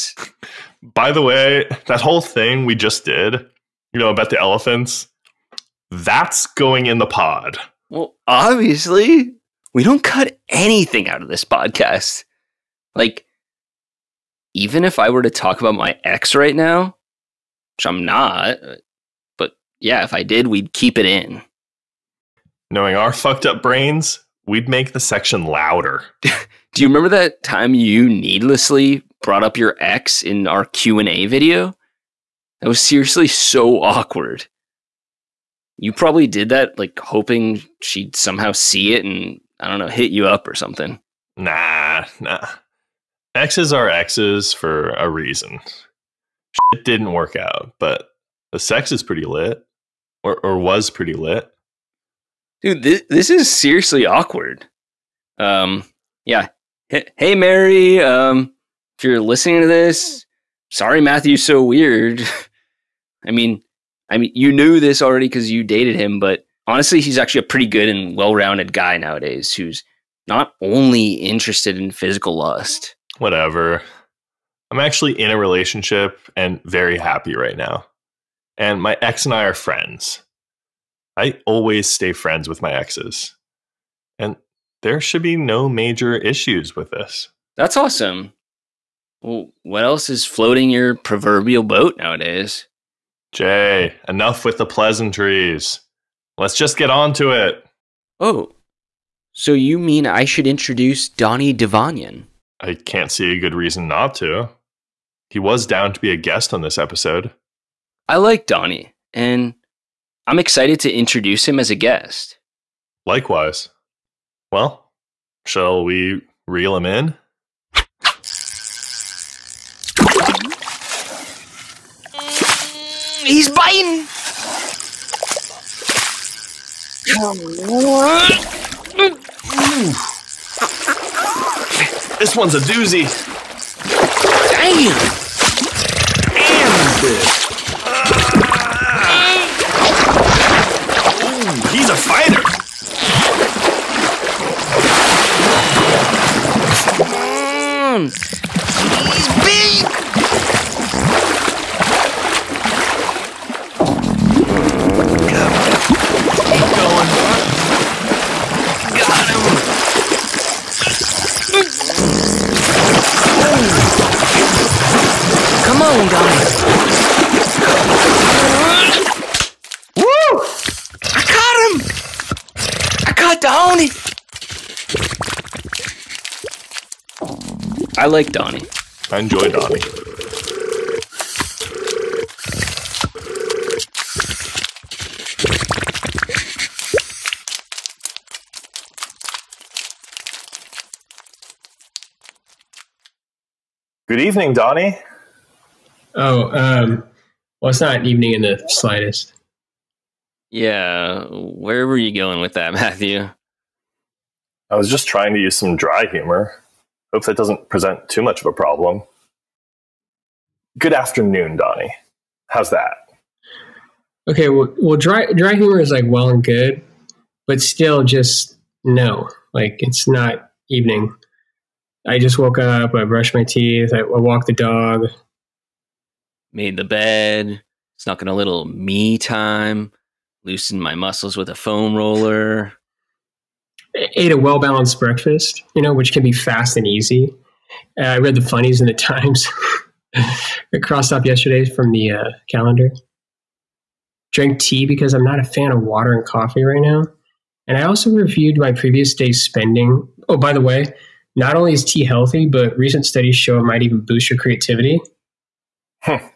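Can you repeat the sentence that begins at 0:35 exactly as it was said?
You probably did that like hoping she'd somehow see it and I don't know, hit you up or something.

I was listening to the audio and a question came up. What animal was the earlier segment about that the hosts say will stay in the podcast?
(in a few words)
elephants.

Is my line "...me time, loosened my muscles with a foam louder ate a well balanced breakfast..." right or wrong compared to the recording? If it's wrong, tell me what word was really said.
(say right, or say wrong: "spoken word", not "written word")
wrong: "roller", not "louder".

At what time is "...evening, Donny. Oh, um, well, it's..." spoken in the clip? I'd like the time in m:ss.
3:14.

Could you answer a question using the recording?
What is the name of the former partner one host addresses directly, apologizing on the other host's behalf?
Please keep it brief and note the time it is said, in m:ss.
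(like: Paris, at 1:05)
Mary, at 0:57.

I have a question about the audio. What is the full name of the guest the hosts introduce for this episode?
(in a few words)
Donny Divanian.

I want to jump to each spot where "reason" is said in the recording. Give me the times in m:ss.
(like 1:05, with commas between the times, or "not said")
0:45, 1:43.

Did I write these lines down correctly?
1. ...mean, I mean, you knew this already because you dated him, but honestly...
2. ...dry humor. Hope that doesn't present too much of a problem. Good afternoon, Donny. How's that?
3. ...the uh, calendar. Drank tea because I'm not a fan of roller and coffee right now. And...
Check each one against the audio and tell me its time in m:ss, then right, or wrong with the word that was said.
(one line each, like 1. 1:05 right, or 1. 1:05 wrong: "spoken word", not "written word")
1. 1:03 right
2. 3:25 right
3. 4:01 wrong: "water", not "roller".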